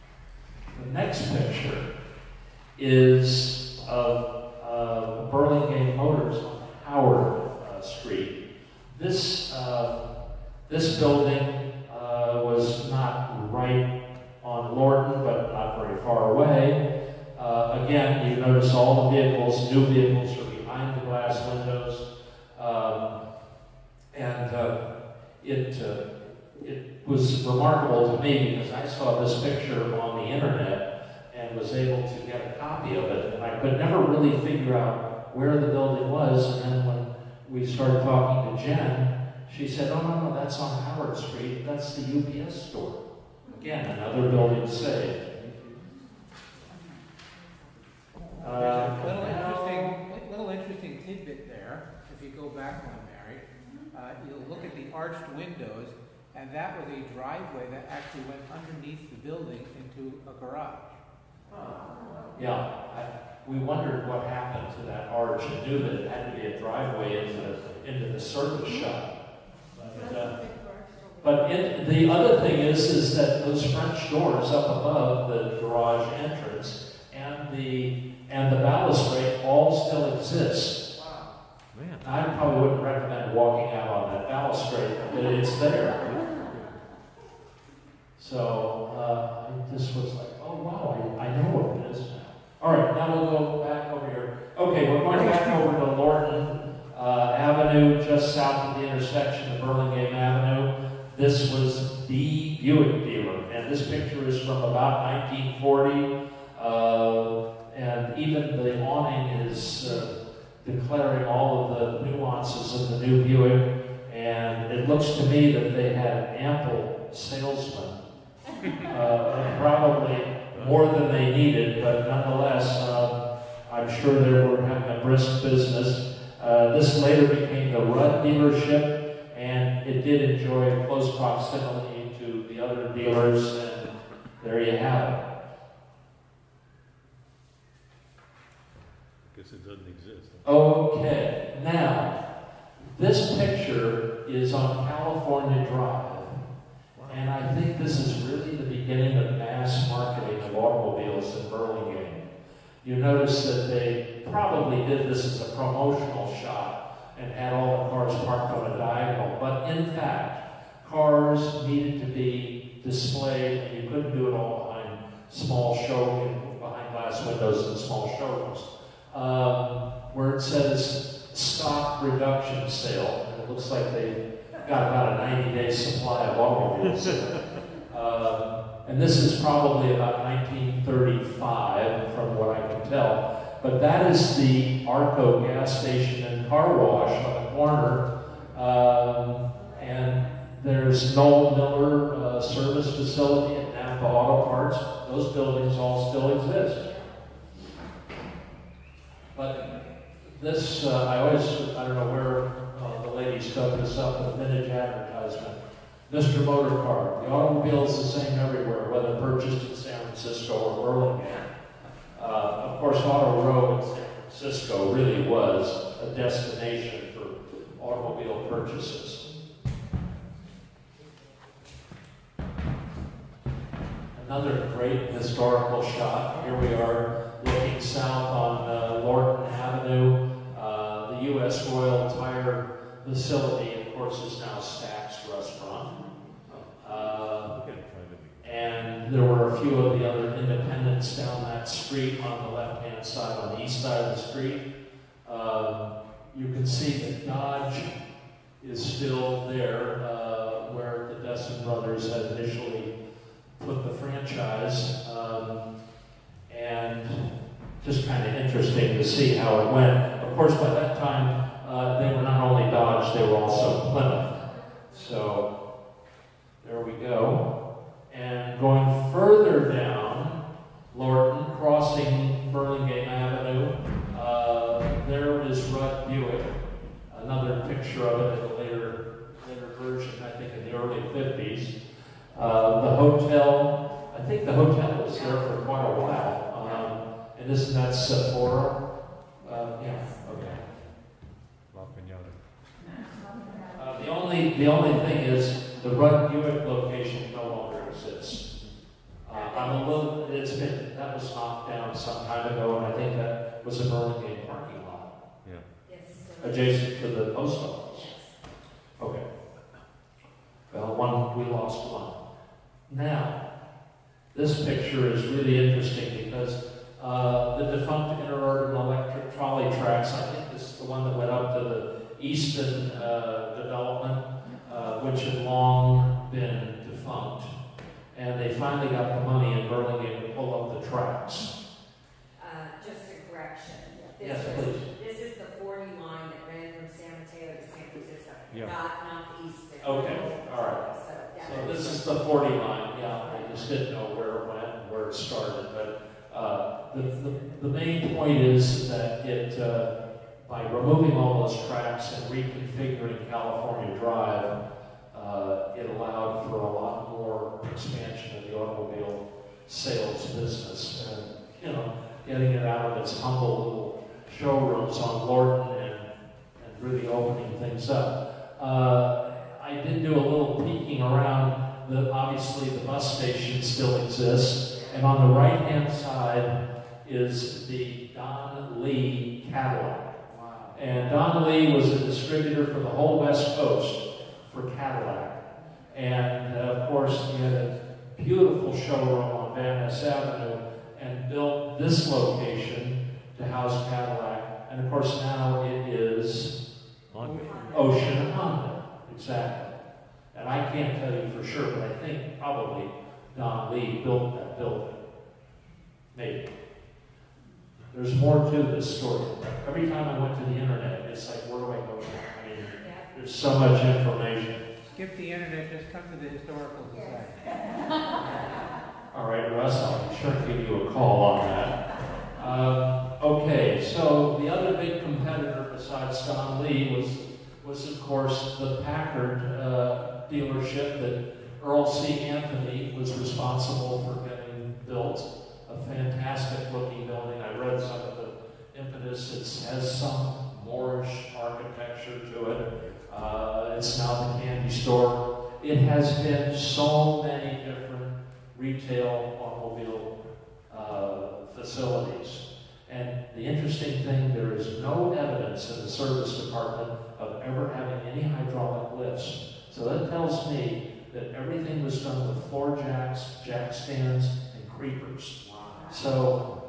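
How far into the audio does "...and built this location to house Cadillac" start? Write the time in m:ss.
6:30.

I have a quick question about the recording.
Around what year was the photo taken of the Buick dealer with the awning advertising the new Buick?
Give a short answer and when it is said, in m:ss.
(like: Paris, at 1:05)
1940, at 1:45.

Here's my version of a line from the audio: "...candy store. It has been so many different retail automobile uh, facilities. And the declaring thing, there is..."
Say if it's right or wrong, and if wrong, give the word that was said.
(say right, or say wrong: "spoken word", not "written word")
wrong: "interesting", not "declaring".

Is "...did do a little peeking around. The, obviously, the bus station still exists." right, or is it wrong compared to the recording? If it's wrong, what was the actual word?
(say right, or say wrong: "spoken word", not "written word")
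right.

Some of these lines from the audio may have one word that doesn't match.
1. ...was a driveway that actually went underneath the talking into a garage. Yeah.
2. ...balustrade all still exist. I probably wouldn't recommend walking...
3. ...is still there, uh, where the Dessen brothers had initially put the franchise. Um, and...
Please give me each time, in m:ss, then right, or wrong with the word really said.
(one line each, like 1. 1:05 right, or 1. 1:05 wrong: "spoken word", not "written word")
1. 0:56 wrong: "building", not "talking"
2. 1:18 right
3. 4:08 right.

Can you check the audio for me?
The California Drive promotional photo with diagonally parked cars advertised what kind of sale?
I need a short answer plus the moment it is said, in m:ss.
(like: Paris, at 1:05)
Stock reduction sale, at 2:51.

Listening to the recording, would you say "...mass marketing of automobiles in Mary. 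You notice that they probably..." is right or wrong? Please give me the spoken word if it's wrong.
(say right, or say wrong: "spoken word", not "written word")
wrong: "Burlingame", not "Mary".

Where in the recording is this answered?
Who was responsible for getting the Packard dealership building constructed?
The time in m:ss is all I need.
7:11.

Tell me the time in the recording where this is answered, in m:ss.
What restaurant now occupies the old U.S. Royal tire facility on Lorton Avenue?
3:54.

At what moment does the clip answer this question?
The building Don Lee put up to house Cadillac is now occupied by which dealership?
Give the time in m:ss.
6:37.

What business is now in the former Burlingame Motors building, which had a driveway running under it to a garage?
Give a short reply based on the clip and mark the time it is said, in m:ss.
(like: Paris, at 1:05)
The UPS store, at 0:41.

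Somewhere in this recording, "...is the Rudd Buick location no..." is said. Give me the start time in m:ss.
4:55.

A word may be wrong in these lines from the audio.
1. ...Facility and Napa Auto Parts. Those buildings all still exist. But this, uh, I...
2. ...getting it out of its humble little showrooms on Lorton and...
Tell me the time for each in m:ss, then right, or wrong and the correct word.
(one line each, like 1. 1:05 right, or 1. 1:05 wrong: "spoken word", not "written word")
1. 3:12 right
2. 6:02 right.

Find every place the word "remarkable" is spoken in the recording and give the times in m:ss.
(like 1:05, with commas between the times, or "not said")
0:27.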